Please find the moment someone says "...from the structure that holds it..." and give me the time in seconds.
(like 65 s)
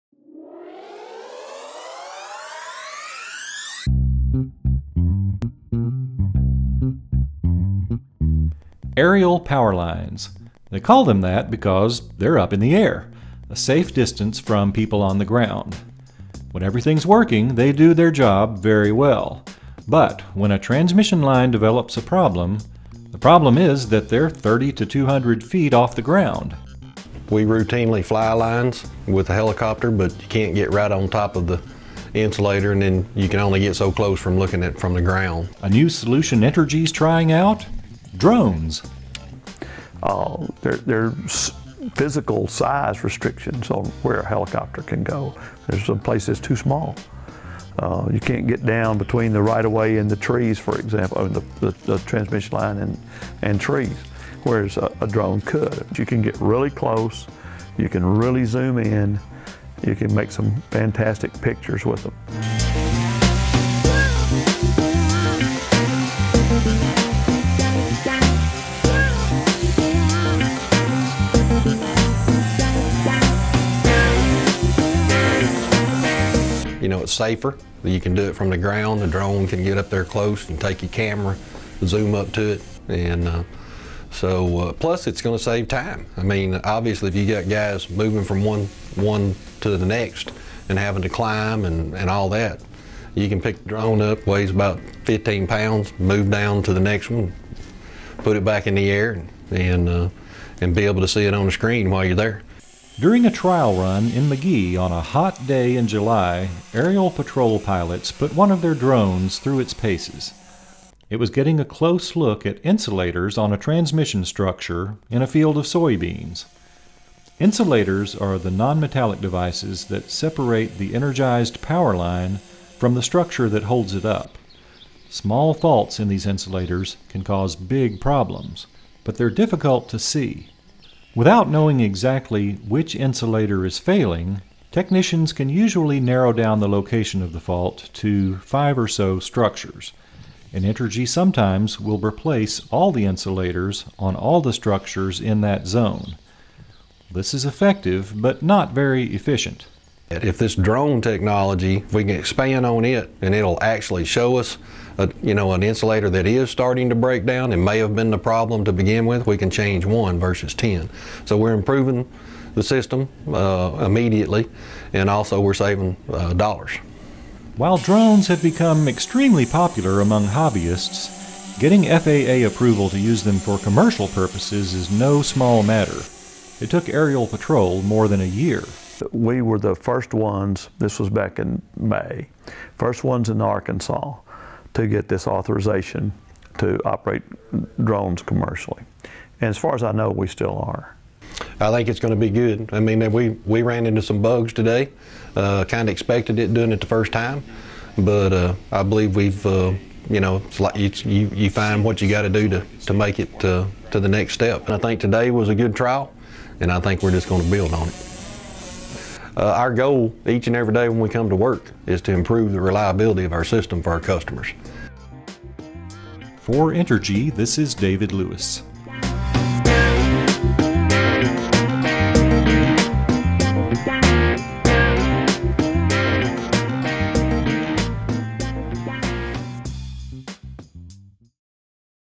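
122 s.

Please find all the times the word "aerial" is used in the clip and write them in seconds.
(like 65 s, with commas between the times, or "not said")
8 s, 106 s, 176 s.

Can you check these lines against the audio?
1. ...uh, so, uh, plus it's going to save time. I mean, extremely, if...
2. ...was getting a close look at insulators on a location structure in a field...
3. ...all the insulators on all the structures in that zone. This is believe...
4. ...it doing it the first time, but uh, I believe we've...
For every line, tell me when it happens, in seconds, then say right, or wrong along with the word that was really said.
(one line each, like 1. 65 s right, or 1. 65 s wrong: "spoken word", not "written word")
1. 83 s wrong: "obviously", not "extremely"
2. 111 s wrong: "transmission", not "location"
3. 142 s wrong: "effective", not "believe"
4. 196 s right.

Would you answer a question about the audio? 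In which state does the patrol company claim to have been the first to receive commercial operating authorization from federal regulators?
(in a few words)
Arkansas.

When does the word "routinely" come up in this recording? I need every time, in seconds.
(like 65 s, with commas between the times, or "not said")
27 s.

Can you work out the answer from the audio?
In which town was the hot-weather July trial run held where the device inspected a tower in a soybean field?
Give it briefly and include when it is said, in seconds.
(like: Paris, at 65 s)
McGehee, at 104 s.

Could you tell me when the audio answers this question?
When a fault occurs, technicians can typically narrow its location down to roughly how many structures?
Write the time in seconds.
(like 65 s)
138 s.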